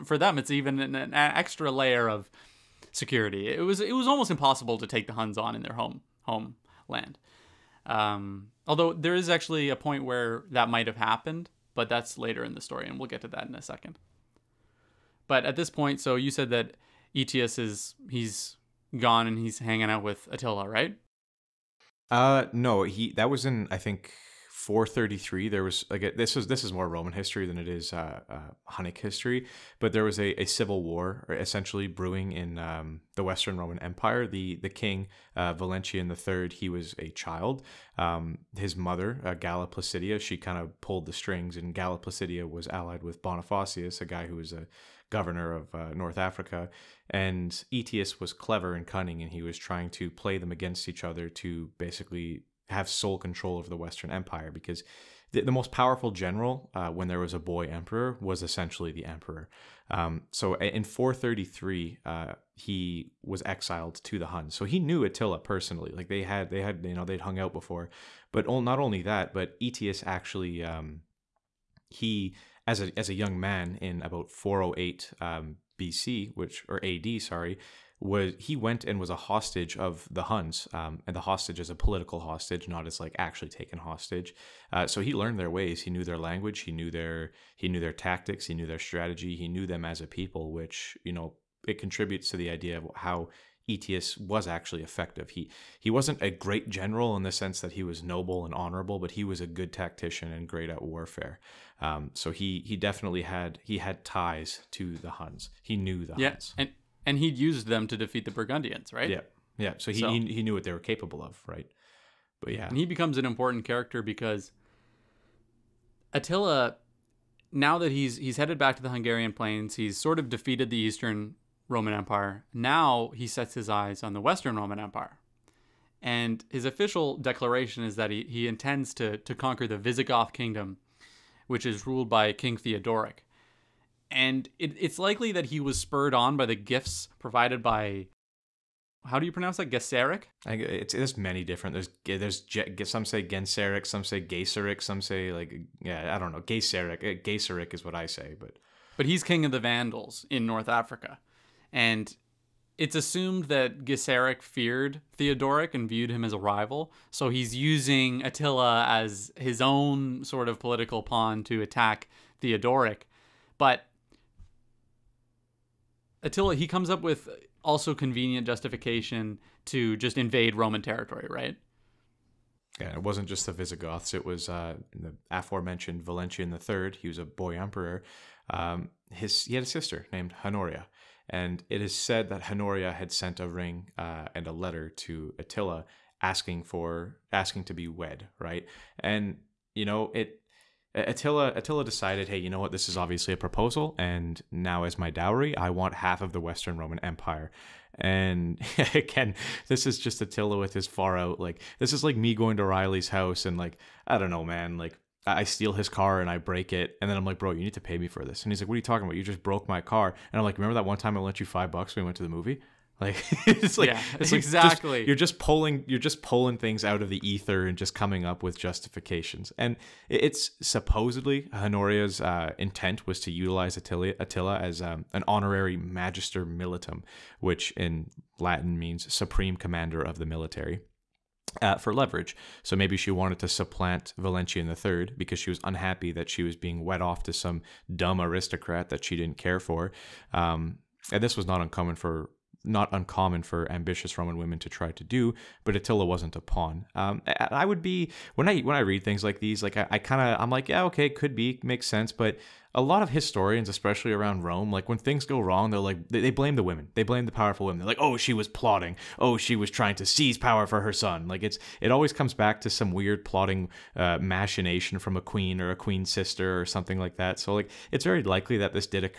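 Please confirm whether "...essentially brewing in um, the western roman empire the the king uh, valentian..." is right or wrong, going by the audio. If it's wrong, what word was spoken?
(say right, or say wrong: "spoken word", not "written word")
right.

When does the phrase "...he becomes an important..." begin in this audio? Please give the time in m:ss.
1:52.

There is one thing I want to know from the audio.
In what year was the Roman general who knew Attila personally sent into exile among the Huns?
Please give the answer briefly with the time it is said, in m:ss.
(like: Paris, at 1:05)
433, at 1:00.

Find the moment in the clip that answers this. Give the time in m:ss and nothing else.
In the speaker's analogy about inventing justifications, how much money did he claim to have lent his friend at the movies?
3:31.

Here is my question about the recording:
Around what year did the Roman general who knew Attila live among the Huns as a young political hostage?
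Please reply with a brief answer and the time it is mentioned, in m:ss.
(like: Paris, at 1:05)
408, at 1:14.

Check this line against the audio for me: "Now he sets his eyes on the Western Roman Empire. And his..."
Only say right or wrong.
right.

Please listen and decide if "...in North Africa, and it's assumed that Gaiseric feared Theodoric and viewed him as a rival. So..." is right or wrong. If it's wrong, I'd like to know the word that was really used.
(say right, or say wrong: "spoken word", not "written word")
right.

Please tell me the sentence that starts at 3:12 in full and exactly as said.
This is obviously a proposal, and now as my dowry, I want half of the Western Roman Empire.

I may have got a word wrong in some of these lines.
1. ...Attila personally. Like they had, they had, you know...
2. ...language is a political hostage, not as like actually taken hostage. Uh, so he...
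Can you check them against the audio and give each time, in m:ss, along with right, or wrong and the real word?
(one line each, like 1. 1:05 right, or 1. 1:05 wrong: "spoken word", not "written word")
1. 1:05 right
2. 1:21 wrong: "hostage", not "language".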